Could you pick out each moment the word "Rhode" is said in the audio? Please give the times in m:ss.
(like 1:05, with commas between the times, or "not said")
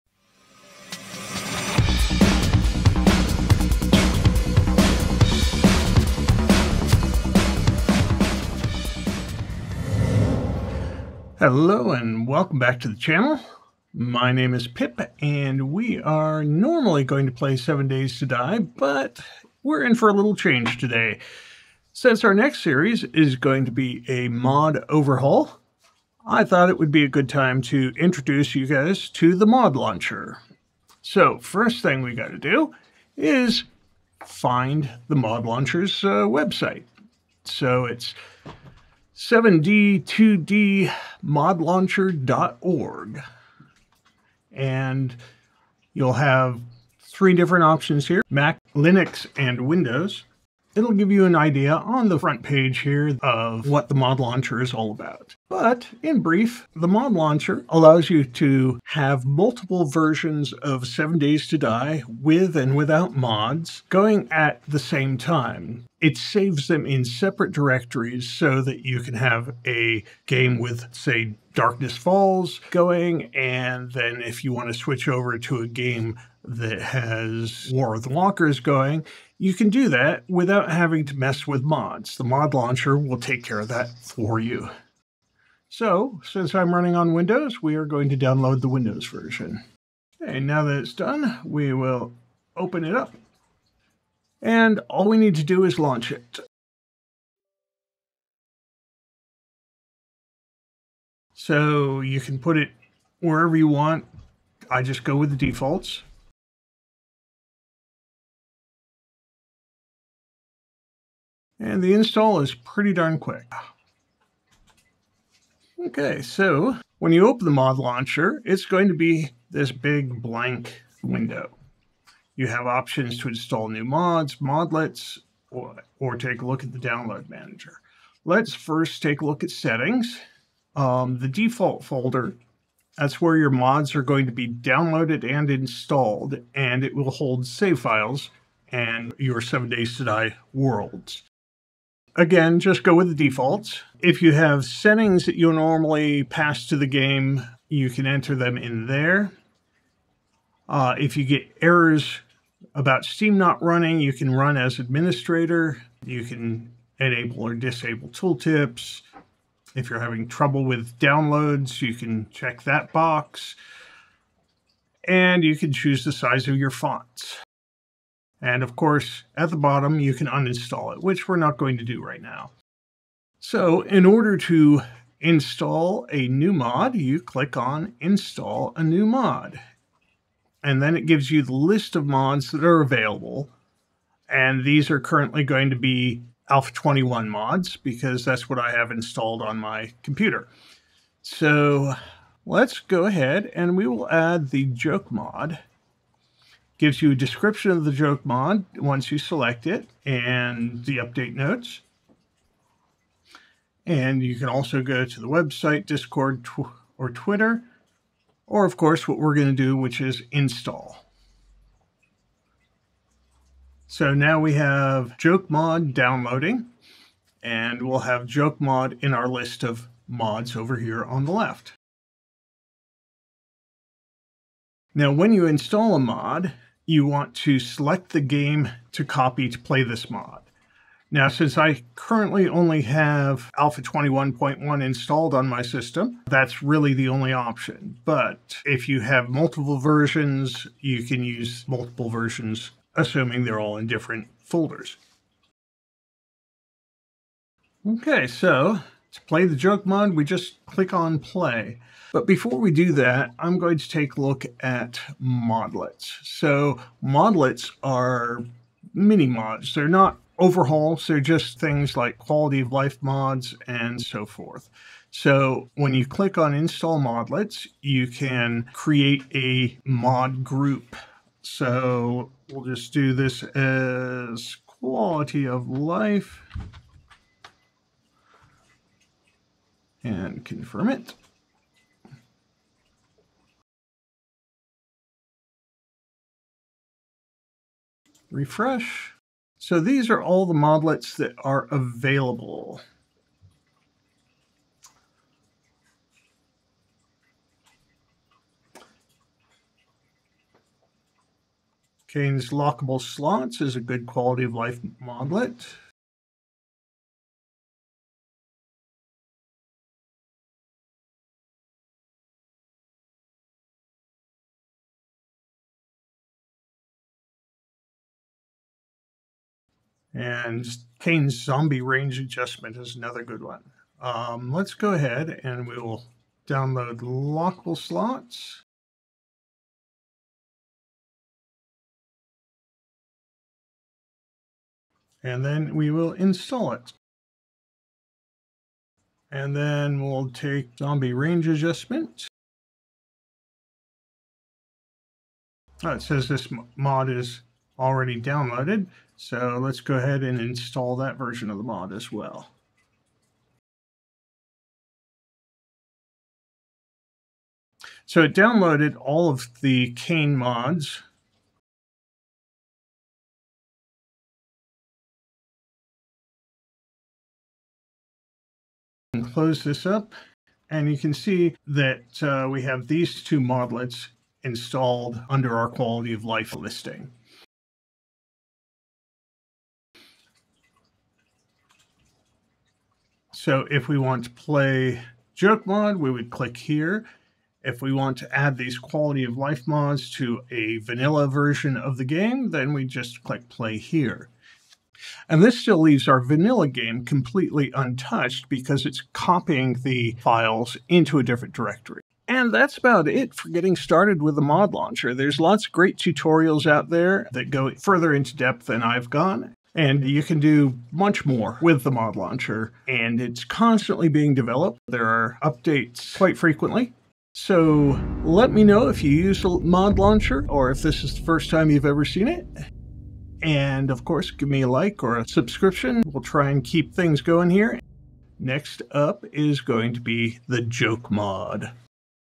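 not said.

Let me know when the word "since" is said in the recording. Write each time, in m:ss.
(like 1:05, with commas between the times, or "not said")
0:21, 1:26, 3:51.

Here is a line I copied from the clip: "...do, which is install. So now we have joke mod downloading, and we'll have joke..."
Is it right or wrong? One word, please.
right.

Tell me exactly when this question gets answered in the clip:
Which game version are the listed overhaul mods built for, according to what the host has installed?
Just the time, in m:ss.
3:06.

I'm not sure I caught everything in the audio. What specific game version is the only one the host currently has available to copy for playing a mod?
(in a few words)
Alpha 21.1.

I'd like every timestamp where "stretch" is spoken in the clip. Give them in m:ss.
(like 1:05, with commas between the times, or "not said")
not said.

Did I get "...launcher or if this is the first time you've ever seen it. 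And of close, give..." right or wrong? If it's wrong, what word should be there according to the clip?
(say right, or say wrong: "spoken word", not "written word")
wrong: "course", not "close".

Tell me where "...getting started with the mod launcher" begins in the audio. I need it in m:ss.
6:43.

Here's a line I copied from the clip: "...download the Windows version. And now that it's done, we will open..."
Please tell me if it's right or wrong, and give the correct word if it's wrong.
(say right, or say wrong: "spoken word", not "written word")
right.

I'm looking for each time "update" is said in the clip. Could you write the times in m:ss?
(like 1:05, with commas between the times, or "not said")
3:20, 6:55.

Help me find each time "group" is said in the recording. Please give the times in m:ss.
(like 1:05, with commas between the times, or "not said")
4:30.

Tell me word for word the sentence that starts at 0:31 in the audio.
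So first thing we got to do is find the mod launcher's uh, website.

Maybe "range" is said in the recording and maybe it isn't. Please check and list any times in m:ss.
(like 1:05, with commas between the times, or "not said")
5:21, 5:41.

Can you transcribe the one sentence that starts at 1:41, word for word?
So you can put it wherever you want.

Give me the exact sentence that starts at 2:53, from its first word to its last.
So in order to install a new mod, you click on install a new mod.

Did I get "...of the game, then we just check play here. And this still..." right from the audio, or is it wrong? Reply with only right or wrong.
wrong.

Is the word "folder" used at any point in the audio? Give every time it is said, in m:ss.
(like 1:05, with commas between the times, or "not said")
2:11, 4:04.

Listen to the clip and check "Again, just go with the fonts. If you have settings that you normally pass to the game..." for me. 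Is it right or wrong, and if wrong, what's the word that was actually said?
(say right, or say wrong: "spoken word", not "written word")
wrong: "defaults", not "fonts".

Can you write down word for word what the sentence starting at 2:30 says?
Uh, if you get errors about Steam not running, you can run as administrator.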